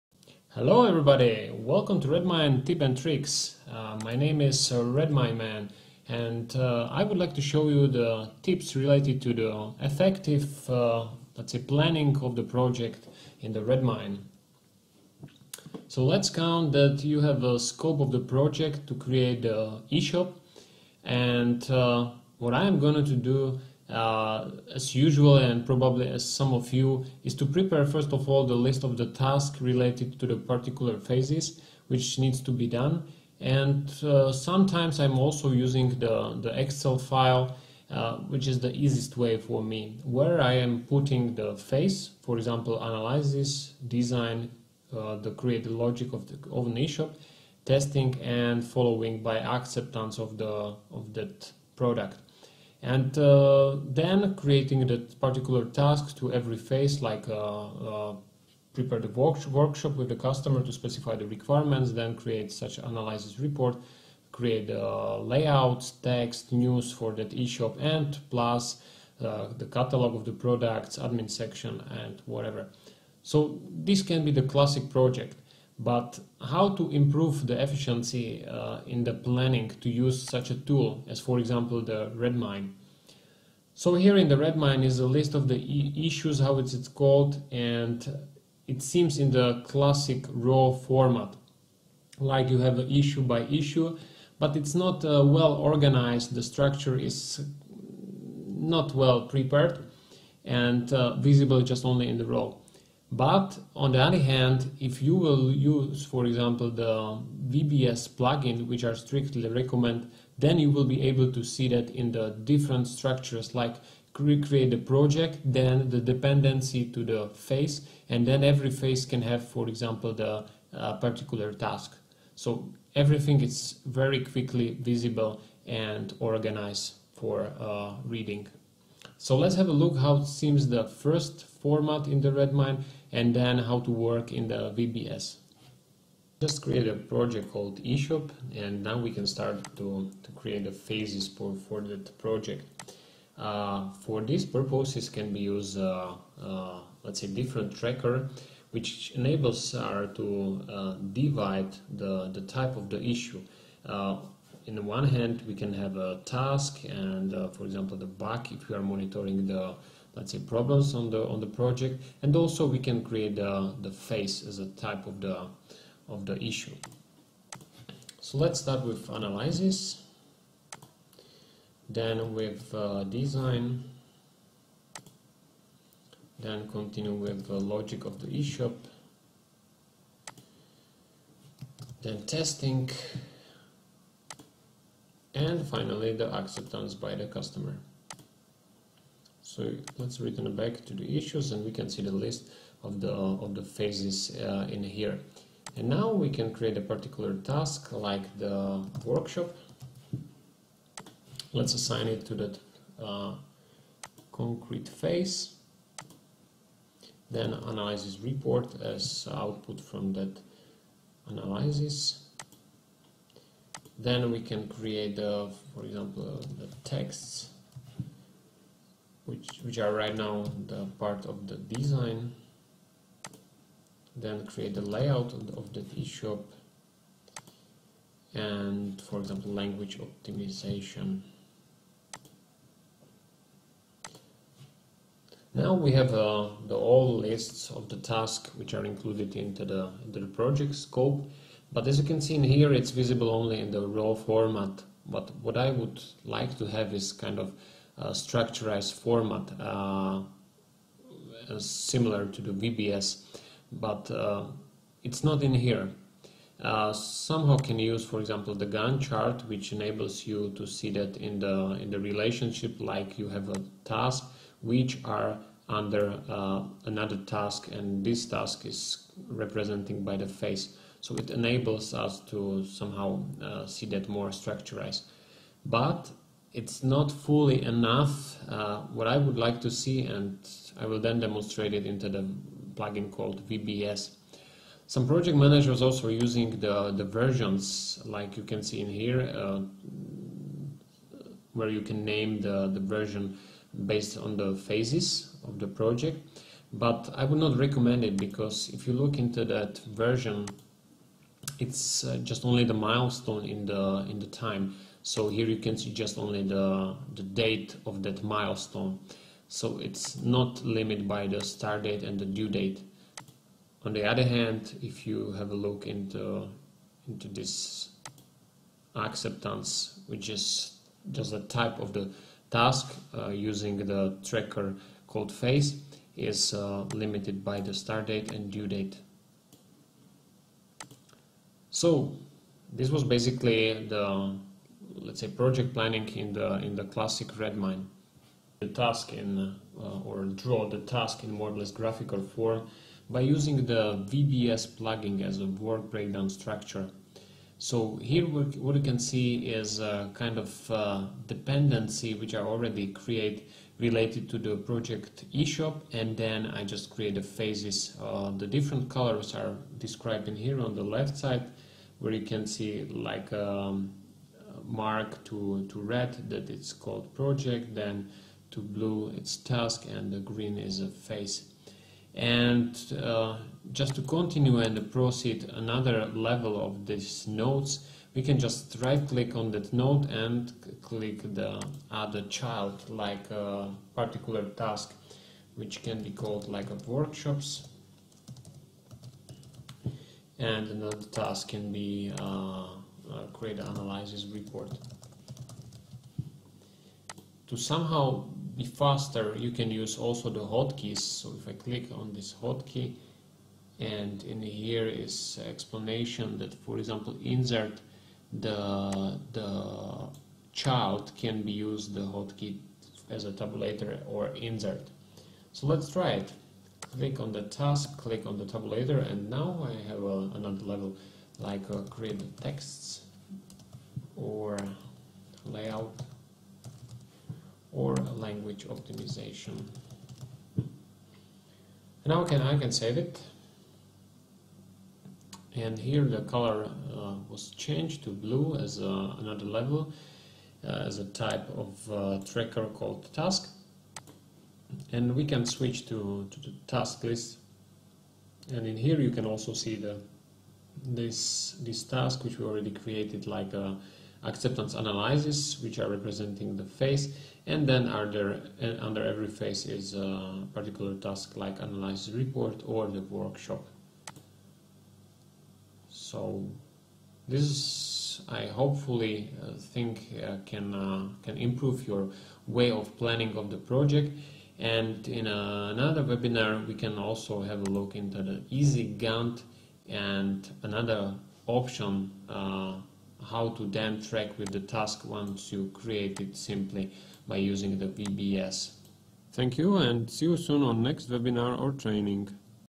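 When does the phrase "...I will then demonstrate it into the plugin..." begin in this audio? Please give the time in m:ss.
4:40.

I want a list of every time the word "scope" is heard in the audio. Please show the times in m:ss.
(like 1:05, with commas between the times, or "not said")
0:17, 4:00.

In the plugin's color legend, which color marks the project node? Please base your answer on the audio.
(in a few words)
red.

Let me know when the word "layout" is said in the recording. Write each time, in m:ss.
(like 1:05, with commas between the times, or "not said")
1:05, 3:44, 7:05.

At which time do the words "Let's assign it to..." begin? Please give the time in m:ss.
3:21.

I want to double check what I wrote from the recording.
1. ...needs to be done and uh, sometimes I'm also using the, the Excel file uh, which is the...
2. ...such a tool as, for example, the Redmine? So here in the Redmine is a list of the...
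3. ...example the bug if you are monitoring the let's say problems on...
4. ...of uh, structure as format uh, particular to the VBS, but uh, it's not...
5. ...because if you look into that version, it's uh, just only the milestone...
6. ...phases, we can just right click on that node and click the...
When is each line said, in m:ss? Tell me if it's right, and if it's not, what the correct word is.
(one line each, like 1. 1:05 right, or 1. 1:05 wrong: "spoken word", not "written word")
1. 0:32 right
2. 1:20 right
3. 2:37 right
4. 4:07 wrong: "similar", not "particular"
5. 4:58 right
6. 6:17 wrong: "nodes", not "phases".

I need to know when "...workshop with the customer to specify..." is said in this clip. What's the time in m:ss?
0:59.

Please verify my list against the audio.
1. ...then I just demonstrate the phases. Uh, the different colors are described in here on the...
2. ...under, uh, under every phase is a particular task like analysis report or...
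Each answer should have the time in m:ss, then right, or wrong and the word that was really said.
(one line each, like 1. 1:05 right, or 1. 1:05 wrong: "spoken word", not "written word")
1. 5:56 wrong: "create", not "demonstrate"
2. 7:37 right.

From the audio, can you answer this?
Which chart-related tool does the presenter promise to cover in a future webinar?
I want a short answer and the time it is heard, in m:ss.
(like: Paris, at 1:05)
easy Gantt, at 7:58.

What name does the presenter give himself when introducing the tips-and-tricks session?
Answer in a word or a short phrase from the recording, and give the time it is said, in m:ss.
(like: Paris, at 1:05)
Redmine Man, at 0:04.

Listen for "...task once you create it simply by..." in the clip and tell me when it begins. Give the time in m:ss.
8:04.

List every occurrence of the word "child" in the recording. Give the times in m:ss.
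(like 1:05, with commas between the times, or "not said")
6:22, 6:50.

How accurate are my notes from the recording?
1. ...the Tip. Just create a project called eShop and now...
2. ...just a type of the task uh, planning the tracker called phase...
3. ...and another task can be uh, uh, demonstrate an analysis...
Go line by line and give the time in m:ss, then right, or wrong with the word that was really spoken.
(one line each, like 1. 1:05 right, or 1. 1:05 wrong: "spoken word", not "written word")
1. 2:14 wrong: "VBS", not "Tip"
2. 5:21 wrong: "using", not "planning"
3. 6:30 wrong: "create", not "demonstrate".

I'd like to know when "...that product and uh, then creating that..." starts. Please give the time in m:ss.
0:51.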